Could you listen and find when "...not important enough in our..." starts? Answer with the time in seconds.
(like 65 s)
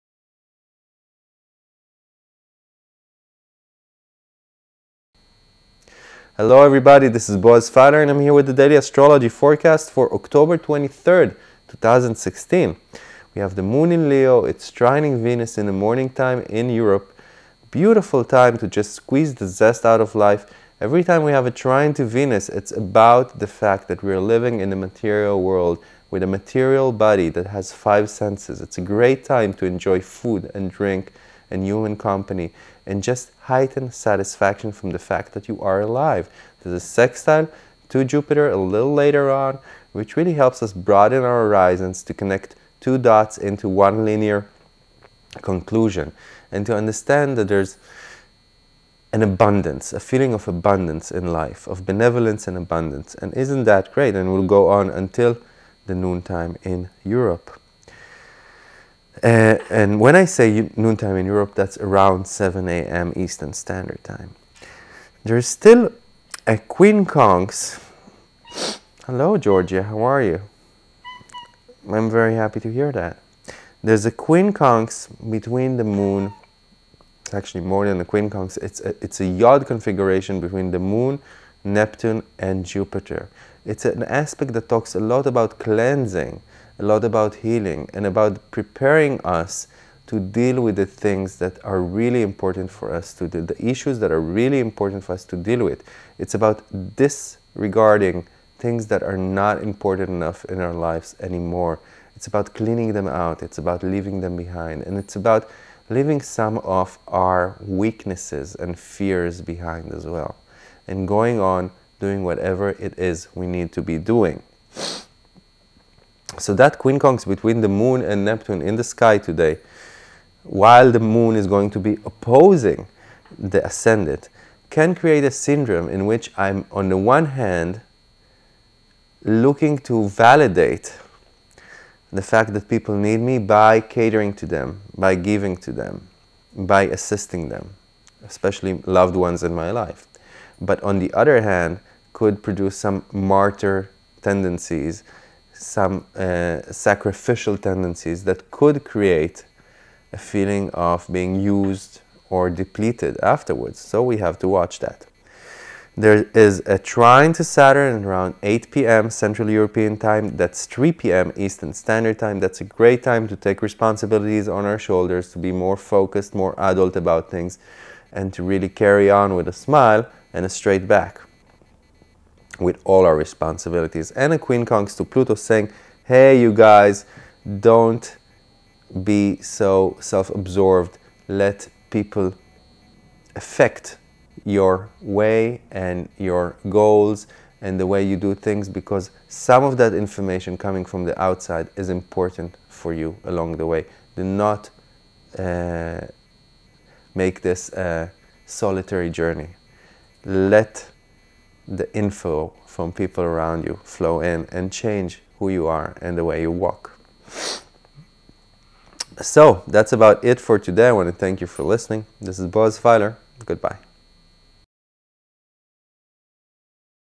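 99 s.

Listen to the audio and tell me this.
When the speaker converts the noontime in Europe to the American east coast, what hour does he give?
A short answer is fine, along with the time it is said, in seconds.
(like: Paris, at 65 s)
7 a.m., at 62 s.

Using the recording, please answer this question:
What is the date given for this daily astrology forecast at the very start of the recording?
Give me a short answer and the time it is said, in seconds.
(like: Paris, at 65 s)
October 23rd, 2016, at 10 s.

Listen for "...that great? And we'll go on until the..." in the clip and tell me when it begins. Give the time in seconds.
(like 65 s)
53 s.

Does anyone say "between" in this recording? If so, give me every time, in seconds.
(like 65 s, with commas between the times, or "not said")
75 s, 80 s, 117 s.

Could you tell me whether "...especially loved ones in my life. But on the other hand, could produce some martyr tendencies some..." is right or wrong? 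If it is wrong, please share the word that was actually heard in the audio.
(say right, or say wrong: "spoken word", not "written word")
right.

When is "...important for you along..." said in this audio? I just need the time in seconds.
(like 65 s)
191 s.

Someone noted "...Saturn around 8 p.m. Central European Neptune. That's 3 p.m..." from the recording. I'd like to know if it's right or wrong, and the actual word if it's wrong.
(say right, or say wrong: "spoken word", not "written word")
wrong: "Time", not "Neptune".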